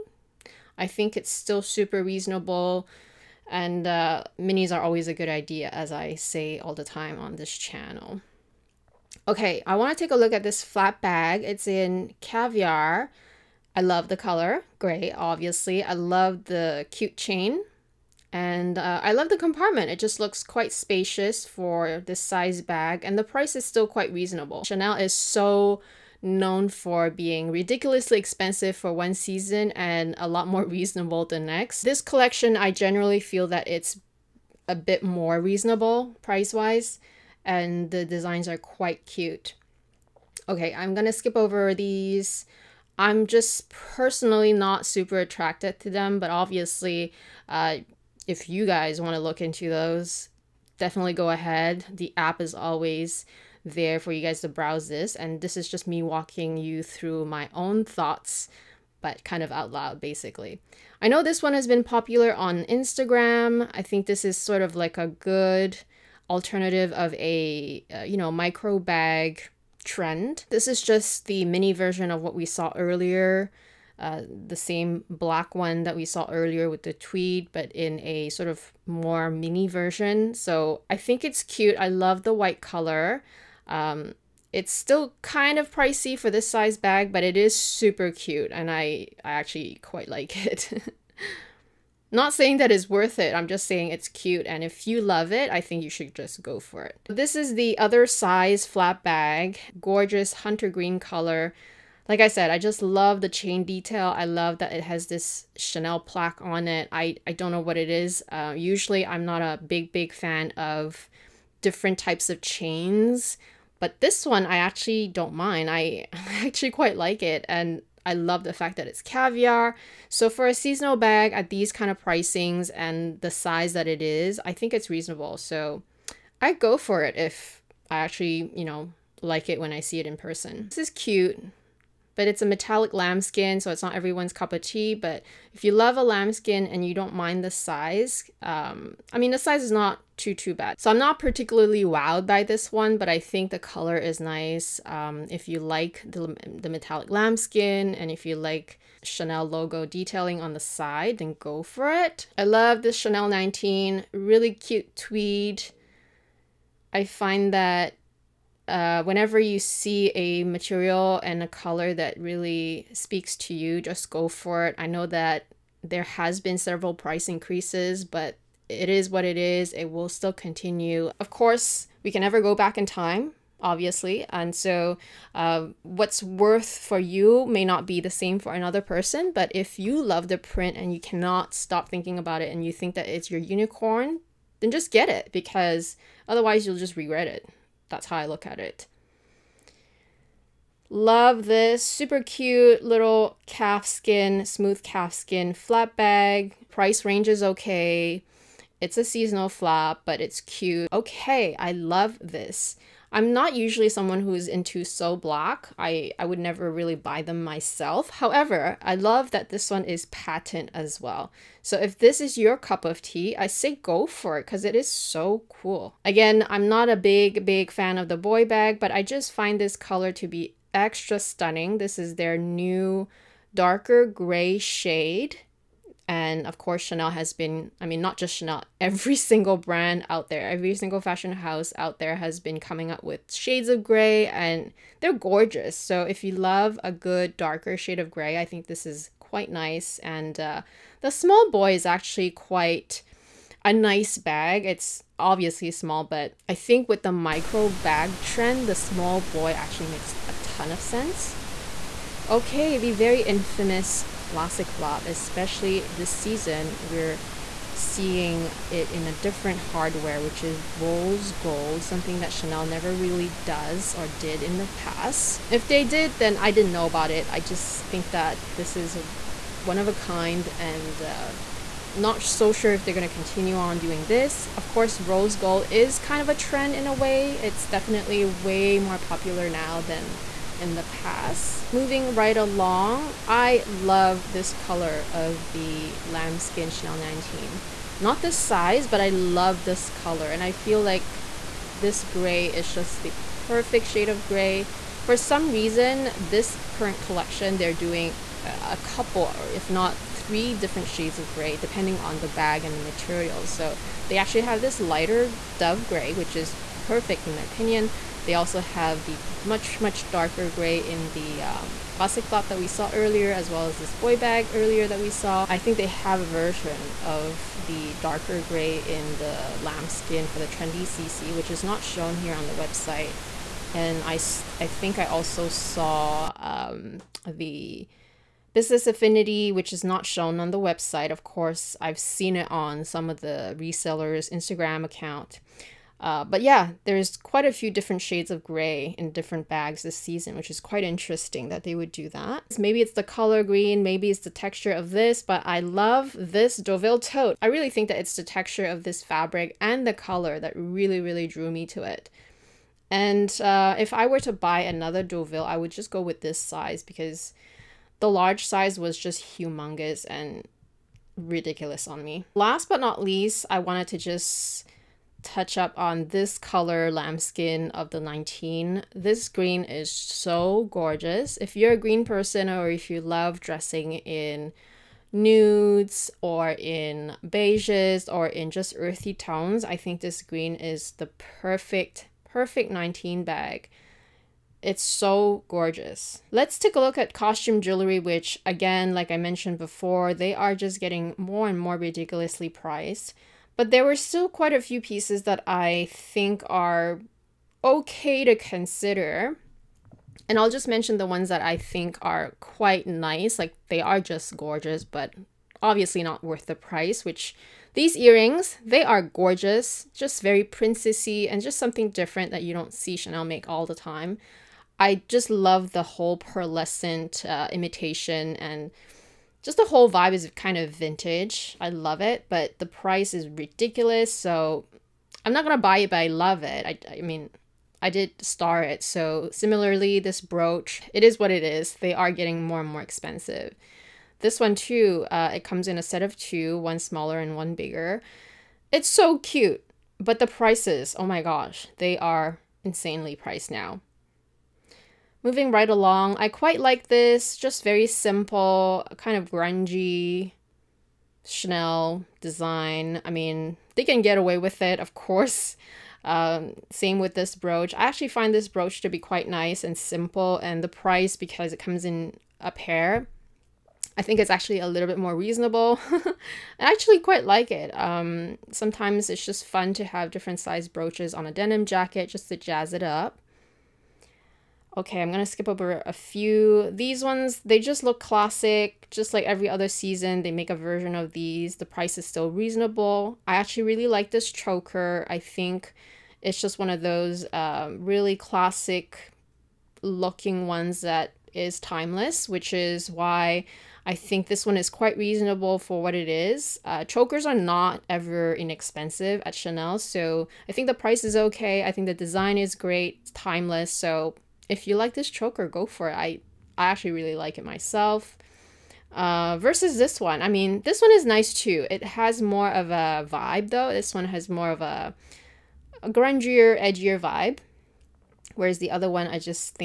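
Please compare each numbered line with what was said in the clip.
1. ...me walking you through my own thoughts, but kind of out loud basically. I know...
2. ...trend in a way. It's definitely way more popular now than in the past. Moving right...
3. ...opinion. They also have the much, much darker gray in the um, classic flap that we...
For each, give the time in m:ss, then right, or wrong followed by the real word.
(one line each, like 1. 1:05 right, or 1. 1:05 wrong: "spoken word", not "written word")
1. 0:55 right
2. 4:36 right
3. 5:07 right.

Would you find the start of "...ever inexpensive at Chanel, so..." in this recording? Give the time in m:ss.
8:17.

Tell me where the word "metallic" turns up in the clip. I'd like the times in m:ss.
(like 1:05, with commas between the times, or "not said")
2:12, 2:26.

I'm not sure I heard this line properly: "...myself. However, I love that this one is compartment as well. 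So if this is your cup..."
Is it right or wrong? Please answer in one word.
wrong.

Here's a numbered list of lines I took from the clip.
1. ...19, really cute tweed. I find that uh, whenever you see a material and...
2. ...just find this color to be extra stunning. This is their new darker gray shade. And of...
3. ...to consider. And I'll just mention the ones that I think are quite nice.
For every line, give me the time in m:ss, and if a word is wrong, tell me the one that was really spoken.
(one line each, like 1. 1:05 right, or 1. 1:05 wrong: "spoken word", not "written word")
1. 2:33 right
2. 3:39 right
3. 6:38 right.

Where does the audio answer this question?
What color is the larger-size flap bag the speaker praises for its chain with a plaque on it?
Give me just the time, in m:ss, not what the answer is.
1:40.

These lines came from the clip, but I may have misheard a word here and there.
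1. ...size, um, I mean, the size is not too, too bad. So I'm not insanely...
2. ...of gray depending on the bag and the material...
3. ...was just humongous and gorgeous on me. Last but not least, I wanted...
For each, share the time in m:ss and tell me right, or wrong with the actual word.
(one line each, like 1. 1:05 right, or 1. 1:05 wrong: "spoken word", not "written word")
1. 2:17 wrong: "particularly", not "insanely"
2. 5:01 right
3. 5:58 wrong: "ridiculous", not "gorgeous".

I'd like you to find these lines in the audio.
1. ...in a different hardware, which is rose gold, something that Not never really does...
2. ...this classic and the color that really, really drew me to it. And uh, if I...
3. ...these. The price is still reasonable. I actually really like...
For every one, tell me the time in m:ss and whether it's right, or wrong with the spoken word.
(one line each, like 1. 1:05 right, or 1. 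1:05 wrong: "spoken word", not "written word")
1. 4:18 wrong: "Chanel", not "Not"
2. 5:48 wrong: "fabric", not "classic"
3. 8:01 right.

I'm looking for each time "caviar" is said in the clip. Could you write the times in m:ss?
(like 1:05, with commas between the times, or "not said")
0:12, 1:59.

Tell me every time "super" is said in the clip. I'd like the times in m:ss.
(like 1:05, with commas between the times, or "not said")
0:01, 0:44, 1:27, 3:11.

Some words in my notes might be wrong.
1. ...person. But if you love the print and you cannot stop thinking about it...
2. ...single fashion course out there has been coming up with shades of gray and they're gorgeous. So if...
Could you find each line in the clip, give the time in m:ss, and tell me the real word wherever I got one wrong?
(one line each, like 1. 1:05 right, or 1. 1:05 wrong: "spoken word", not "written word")
1. 2:58 right
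2. 3:50 wrong: "house", not "course".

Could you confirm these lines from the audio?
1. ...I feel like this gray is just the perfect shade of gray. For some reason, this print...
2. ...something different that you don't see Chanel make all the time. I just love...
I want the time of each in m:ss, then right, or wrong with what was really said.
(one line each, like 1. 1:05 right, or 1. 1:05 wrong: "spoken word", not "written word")
1. 4:50 wrong: "current", not "print"
2. 6:51 right.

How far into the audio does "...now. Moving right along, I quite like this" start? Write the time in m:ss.
7:23.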